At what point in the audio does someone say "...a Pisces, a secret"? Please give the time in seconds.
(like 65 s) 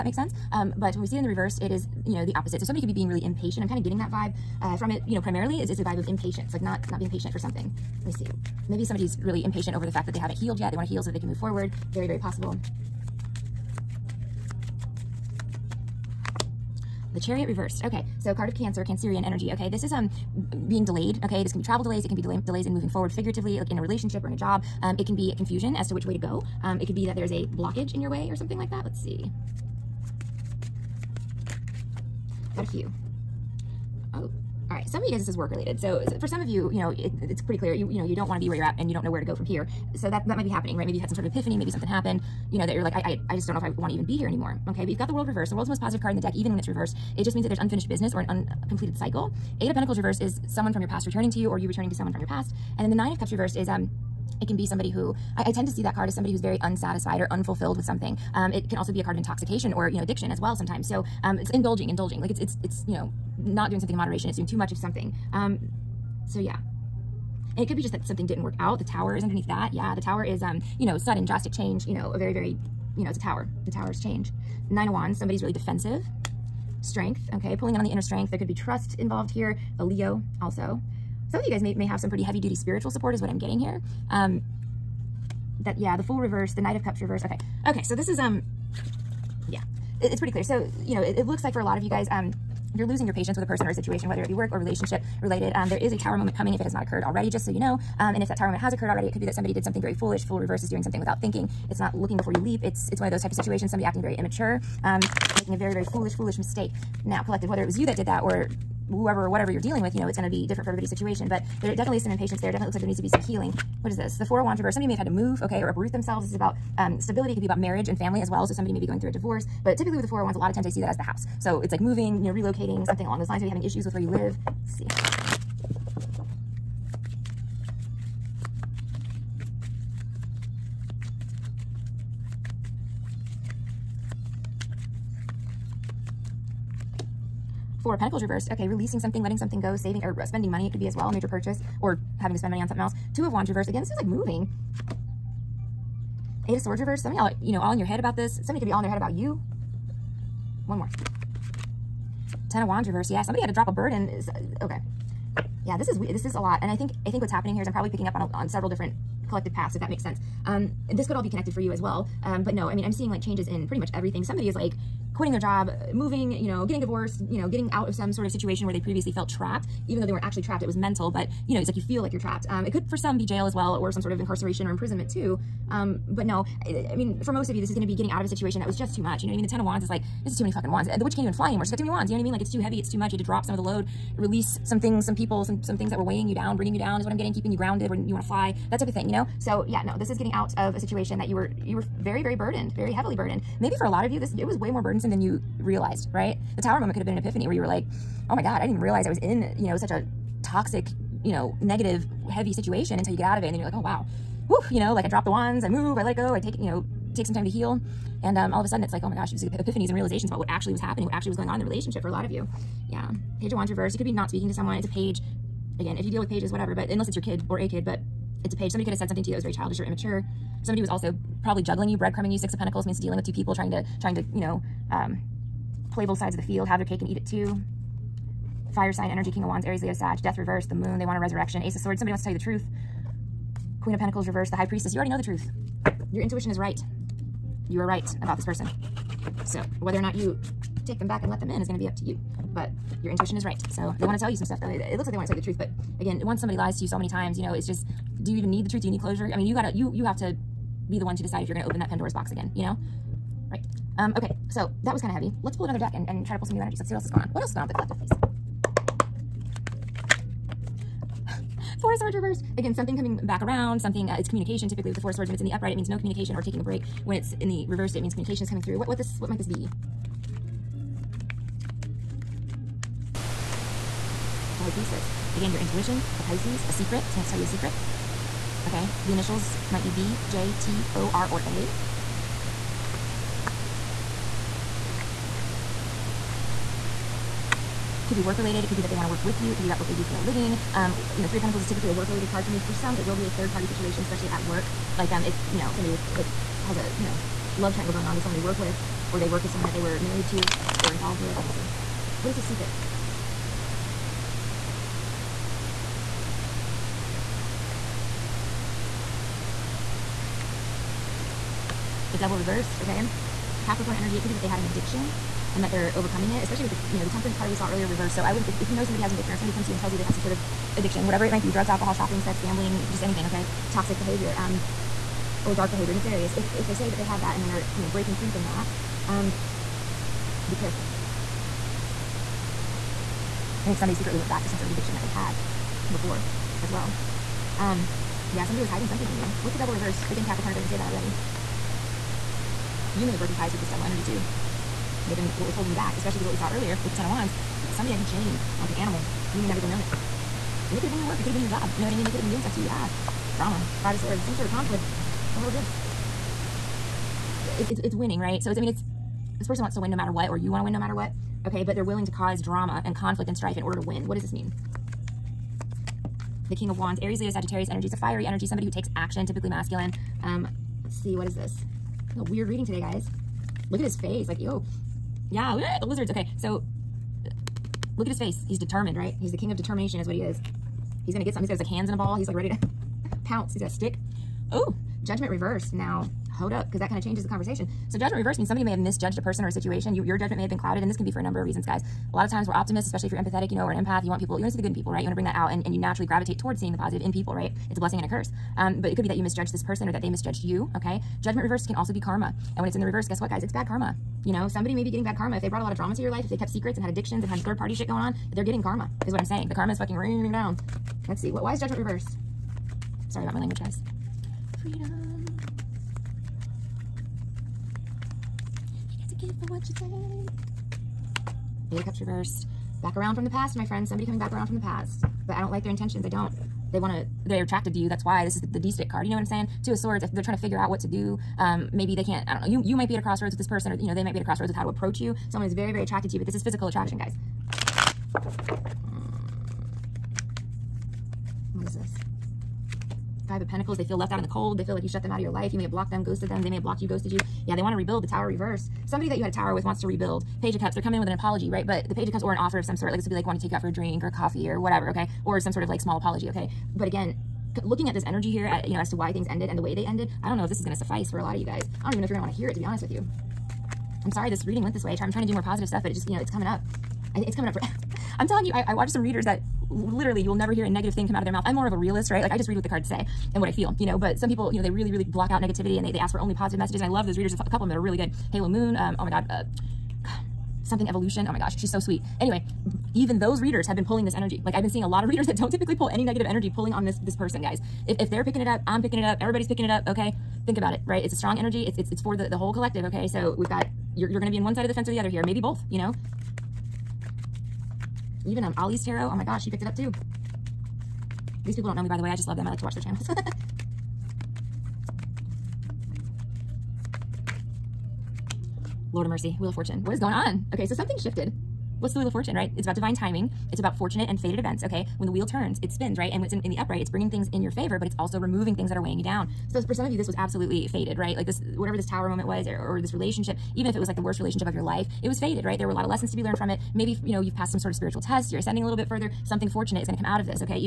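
276 s.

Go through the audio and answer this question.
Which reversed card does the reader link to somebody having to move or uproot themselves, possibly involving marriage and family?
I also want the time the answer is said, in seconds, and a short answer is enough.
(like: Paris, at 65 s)
Four of Wands, at 114 s.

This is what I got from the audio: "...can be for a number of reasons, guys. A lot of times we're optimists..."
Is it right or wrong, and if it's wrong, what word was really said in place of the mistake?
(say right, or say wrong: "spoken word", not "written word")
right.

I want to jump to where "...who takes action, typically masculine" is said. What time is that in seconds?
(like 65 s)
368 s.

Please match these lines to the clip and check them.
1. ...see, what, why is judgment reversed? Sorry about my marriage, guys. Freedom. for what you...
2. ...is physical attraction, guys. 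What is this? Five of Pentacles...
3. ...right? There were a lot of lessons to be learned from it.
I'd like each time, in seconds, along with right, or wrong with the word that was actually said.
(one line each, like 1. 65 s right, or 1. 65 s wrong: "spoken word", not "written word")
1. 411 s wrong: "language", not "marriage"
2. 436 s right
3. 525 s right.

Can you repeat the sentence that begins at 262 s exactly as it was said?
Again, something coming back around, something, uh, it's communication typically with the Four Swords.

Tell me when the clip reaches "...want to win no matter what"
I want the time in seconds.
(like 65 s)
360 s.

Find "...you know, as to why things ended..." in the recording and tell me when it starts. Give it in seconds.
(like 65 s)
458 s.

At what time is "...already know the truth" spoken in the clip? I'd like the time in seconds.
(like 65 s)
234 s.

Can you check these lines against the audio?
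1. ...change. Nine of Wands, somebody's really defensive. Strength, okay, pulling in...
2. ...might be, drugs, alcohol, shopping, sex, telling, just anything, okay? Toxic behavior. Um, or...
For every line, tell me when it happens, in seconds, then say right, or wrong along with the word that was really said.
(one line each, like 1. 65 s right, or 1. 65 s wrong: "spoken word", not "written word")
1. 73 s right
2. 321 s wrong: "gambling", not "telling".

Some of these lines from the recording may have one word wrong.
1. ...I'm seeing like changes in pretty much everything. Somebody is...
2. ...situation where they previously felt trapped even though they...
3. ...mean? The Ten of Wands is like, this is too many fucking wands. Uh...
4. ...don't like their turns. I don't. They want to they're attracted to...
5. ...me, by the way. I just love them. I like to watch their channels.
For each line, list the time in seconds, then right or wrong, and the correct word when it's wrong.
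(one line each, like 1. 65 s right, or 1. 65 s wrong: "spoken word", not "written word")
1. 162 s right
2. 168 s right
3. 179 s right
4. 425 s wrong: "intentions", not "turns"
5. 501 s right.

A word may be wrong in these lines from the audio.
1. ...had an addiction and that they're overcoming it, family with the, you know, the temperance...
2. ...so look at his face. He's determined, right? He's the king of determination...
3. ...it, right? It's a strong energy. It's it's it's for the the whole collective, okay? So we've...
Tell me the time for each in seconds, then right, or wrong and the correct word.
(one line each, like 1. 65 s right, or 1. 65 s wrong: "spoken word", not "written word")
1. 314 s wrong: "especially", not "family"
2. 376 s right
3. 490 s right.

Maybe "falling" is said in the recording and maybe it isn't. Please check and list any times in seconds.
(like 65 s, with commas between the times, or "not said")
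not said.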